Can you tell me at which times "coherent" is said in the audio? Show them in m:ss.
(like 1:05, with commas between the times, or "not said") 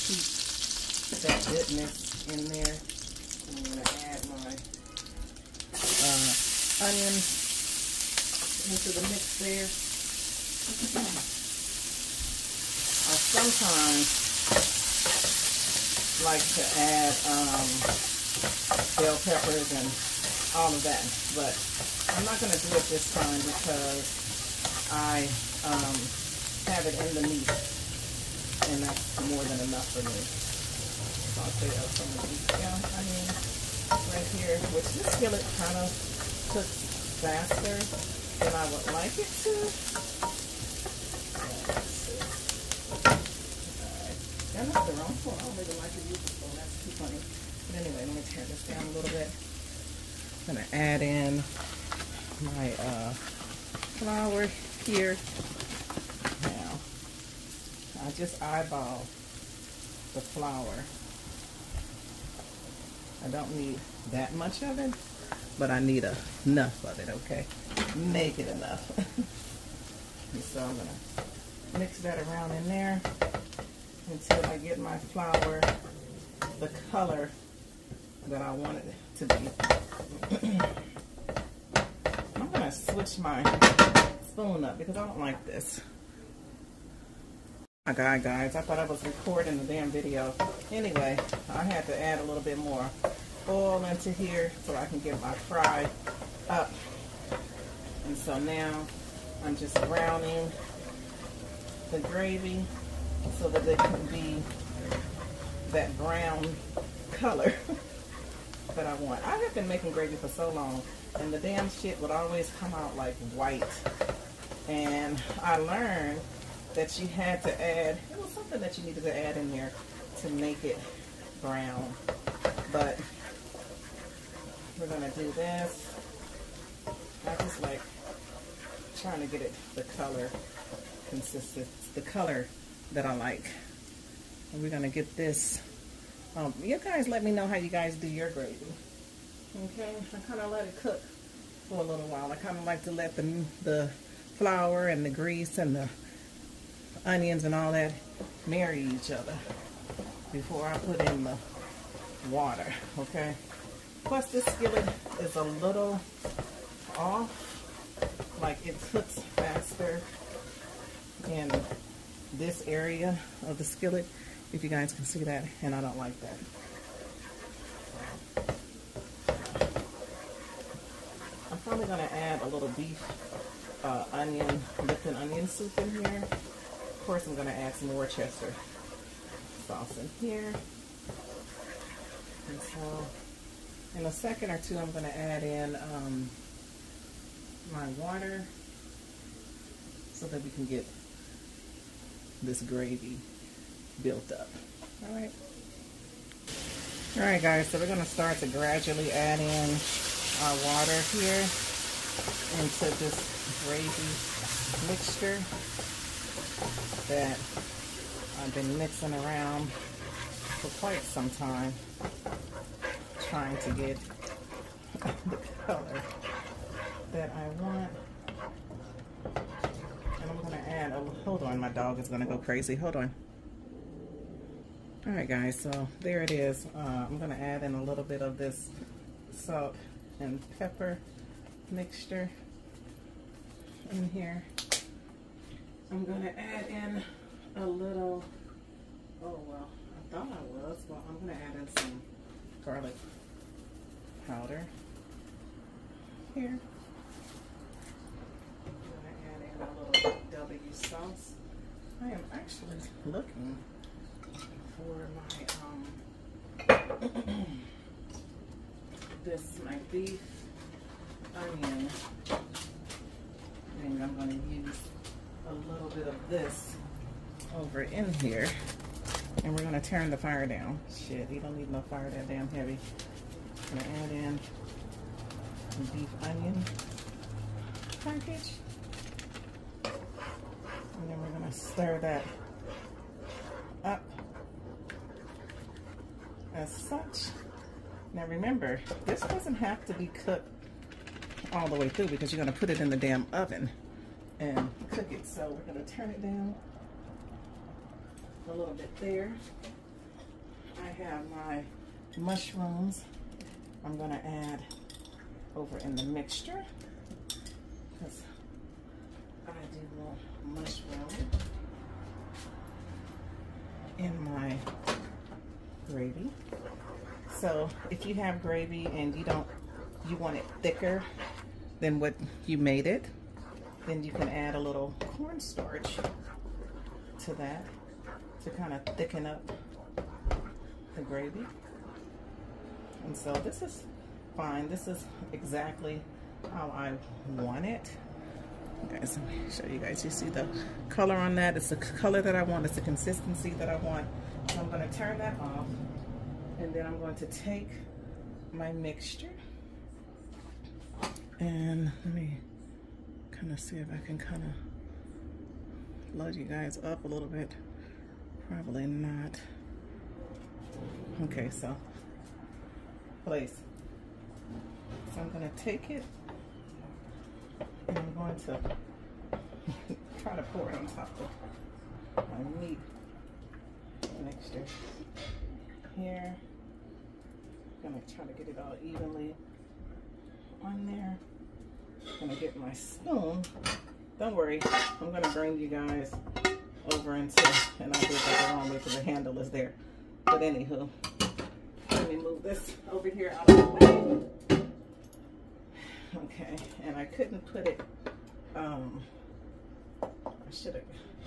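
not said.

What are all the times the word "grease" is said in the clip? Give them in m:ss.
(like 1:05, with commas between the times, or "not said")
2:25.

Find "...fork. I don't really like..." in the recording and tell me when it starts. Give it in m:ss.
0:45.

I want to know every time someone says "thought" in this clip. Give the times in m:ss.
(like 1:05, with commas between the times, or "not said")
1:28, 4:00.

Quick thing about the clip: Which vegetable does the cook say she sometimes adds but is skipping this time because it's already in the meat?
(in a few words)
Bell peppers.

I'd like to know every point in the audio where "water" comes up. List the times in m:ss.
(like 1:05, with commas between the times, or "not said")
2:32, 3:08, 3:20.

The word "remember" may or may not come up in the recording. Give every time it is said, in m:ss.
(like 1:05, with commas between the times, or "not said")
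4:48.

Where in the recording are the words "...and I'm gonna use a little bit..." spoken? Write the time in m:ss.
4:23.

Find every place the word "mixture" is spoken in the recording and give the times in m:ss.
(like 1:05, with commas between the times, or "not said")
3:24, 3:51, 5:06, 5:48, 6:14.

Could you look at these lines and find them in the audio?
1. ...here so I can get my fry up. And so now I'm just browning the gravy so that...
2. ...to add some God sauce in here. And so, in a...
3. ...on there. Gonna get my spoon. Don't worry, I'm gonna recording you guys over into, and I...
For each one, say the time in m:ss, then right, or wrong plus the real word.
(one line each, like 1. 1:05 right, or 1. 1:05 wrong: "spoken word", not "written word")
1. 1:34 right
2. 2:57 wrong: "Worcester", not "God"
3. 6:20 wrong: "bring", not "recording".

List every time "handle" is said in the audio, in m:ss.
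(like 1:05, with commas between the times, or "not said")
6:29.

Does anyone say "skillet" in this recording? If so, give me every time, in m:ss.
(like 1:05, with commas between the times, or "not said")
0:35, 2:34, 2:43.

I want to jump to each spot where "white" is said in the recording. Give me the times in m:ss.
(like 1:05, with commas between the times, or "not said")
1:53.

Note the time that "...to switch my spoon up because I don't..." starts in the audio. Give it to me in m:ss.
1:22.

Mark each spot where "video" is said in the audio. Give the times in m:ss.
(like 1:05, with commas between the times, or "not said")
1:29.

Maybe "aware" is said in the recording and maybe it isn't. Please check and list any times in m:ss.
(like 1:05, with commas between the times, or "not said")
not said.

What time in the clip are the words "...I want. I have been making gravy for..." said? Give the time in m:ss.
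1:48.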